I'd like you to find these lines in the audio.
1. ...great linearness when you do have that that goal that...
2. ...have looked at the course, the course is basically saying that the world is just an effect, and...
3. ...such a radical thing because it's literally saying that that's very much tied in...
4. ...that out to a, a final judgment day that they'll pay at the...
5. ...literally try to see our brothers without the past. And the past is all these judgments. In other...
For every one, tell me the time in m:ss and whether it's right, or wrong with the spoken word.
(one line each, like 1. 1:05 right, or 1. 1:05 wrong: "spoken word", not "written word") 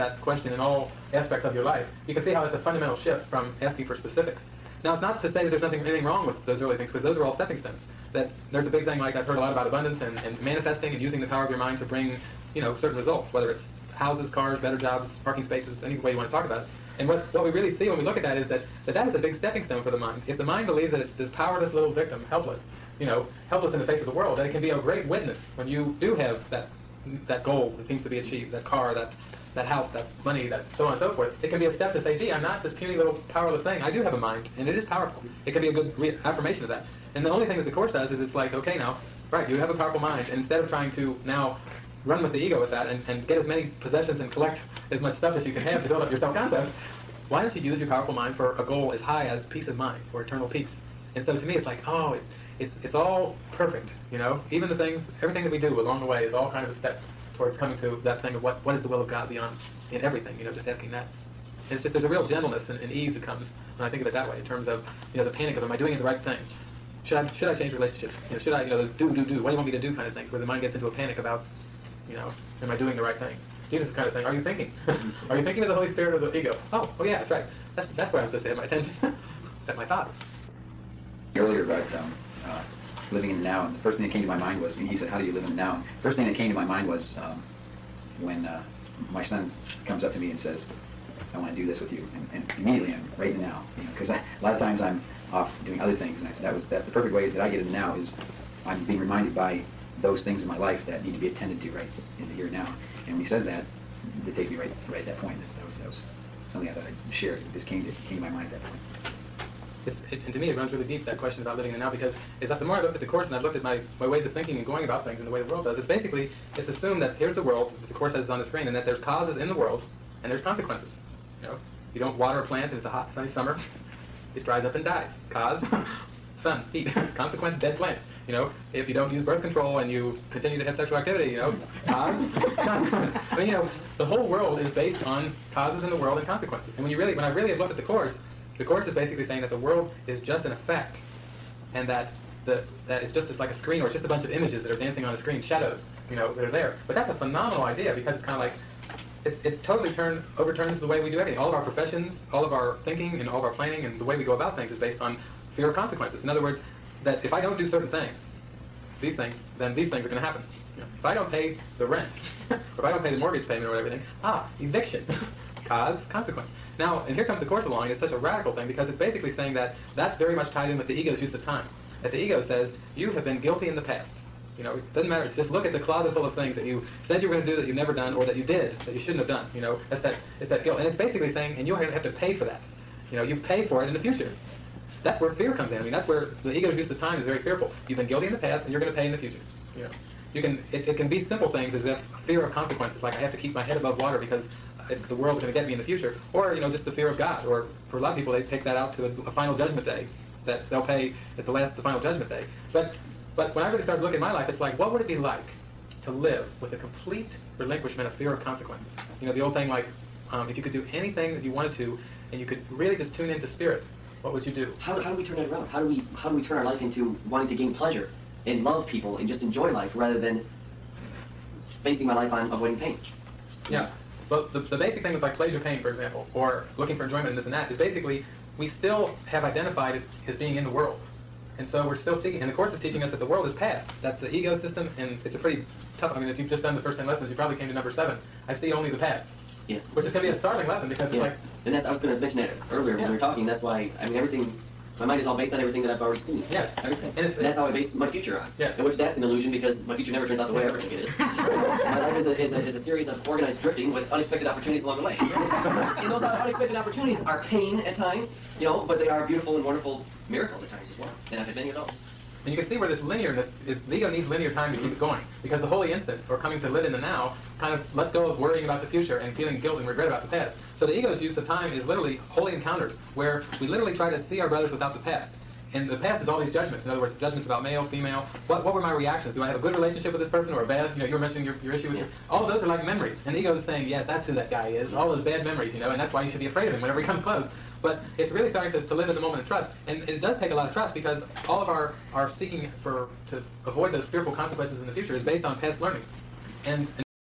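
1. 0:24 wrong: "witness", not "linearness"
2. 2:17 right
3. 2:47 wrong: "basically", not "literally"
4. 3:18 right
5. 4:33 right.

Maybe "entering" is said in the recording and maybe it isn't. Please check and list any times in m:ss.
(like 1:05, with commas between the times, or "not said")
not said.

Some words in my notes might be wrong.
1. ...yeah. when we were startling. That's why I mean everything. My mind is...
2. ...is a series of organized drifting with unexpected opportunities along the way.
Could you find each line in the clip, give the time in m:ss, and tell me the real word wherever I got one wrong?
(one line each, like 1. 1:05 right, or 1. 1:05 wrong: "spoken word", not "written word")
1. 4:02 wrong: "talking", not "startling"
2. 4:12 right.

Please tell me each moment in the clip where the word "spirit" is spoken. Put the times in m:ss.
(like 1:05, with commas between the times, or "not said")
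1:15, 3:33.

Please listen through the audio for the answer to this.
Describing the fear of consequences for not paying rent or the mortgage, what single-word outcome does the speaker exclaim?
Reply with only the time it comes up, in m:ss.
2:44.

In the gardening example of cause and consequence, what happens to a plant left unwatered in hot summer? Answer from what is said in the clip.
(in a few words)
Dries up and dies.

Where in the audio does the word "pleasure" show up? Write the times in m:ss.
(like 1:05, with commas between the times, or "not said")
3:37, 3:45.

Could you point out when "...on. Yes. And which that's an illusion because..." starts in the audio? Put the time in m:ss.
4:08.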